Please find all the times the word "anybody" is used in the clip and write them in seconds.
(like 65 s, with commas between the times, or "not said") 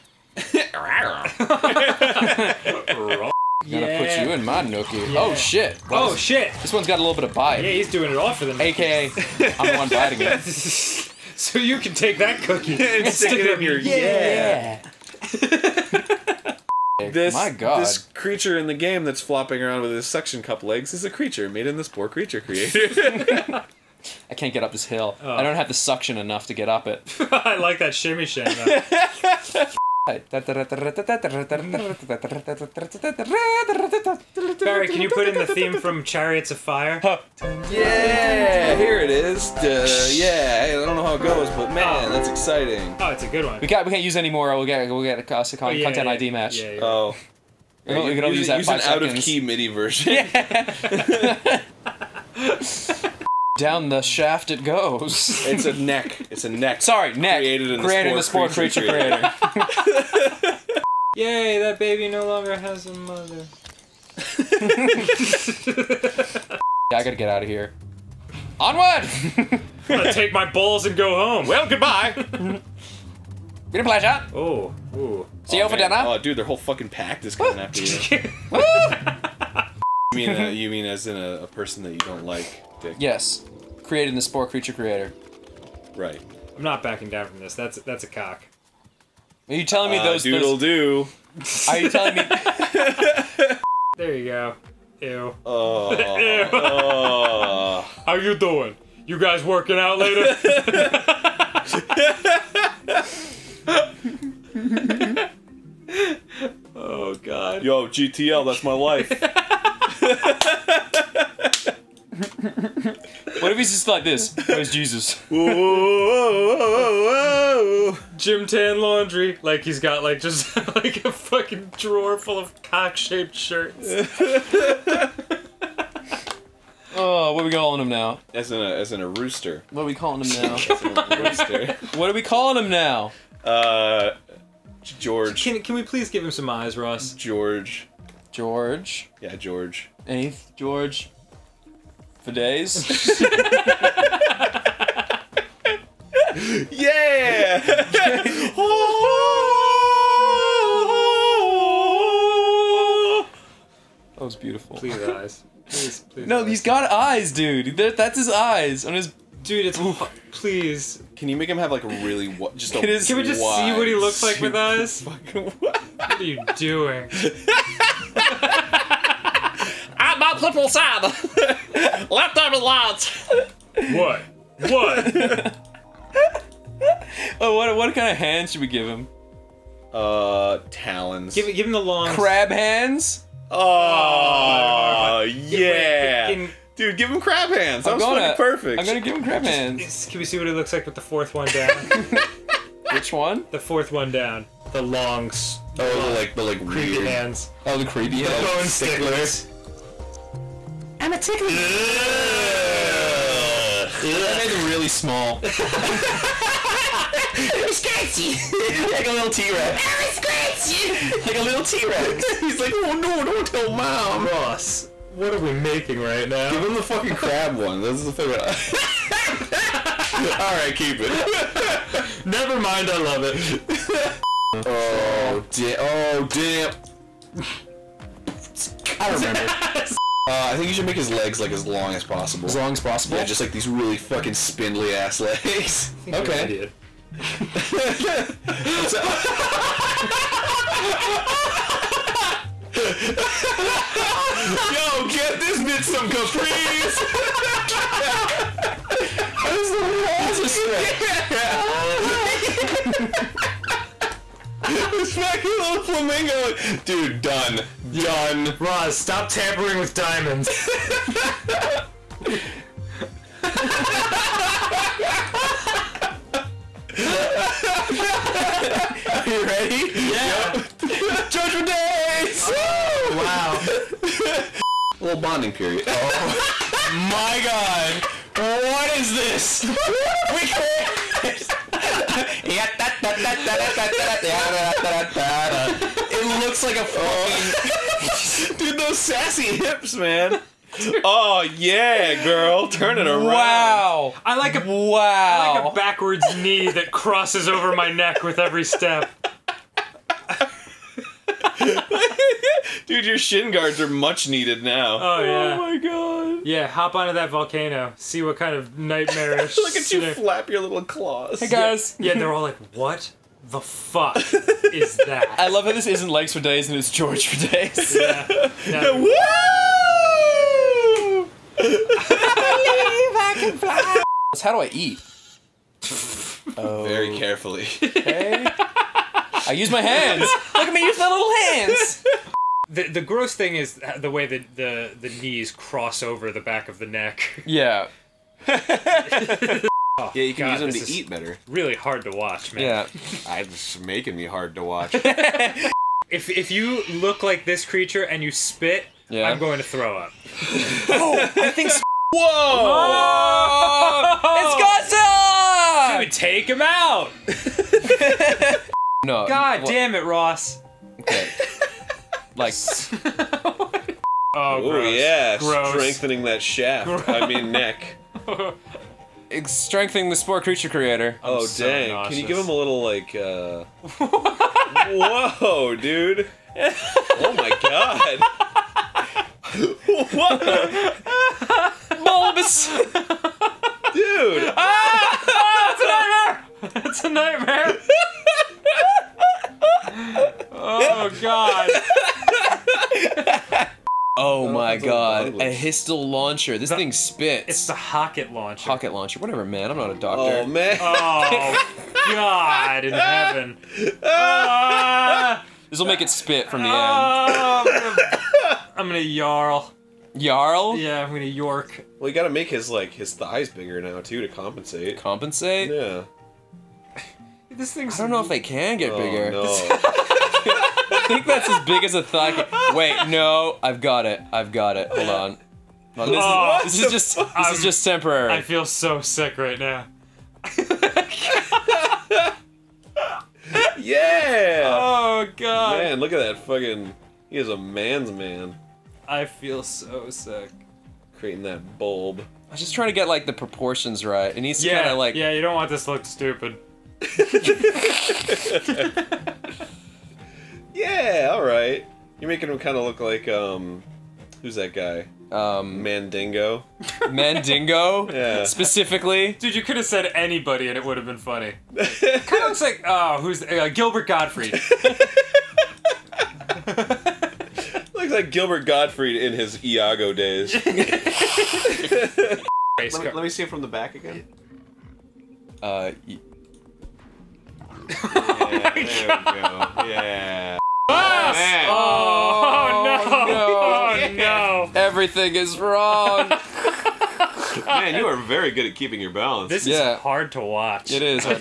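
460 s.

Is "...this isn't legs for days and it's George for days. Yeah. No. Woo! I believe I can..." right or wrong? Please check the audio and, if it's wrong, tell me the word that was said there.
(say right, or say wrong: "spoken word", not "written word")
right.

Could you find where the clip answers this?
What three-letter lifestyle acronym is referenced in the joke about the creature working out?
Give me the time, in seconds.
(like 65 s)
107 s.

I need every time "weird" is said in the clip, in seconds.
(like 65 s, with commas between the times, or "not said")
196 s.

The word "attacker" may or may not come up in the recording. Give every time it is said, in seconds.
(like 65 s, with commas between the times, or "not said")
not said.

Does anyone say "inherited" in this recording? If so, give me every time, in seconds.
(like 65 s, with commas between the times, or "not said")
not said.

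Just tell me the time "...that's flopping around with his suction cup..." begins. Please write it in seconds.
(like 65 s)
19 s.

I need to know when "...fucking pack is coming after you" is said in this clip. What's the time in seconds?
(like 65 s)
76 s.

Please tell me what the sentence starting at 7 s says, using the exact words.
Yeah, he's doing it all for the night.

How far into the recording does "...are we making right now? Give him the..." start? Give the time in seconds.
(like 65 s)
215 s.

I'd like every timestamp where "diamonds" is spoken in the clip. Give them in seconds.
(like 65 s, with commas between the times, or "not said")
259 s.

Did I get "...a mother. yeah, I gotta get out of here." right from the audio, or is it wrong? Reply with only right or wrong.
right.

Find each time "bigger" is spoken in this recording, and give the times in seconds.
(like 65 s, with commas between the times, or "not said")
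413 s, 418 s.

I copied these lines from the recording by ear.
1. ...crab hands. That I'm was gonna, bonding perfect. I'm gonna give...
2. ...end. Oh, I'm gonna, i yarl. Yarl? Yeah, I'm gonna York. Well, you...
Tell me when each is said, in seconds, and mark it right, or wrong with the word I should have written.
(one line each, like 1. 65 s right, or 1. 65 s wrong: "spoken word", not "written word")
1. 187 s wrong: "fucking", not "bonding"
2. 406 s right.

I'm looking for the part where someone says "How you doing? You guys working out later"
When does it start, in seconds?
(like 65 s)
98 s.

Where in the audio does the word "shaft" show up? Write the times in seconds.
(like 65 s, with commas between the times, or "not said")
54 s, 366 s.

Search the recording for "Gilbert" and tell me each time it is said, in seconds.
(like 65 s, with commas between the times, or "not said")
463 s, 468 s.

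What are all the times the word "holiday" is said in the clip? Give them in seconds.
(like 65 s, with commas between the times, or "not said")
not said.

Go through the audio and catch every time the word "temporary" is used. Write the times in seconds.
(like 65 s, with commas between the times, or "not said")
427 s.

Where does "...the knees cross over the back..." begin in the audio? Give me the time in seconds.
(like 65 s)
334 s.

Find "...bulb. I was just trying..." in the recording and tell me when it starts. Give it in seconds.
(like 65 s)
441 s.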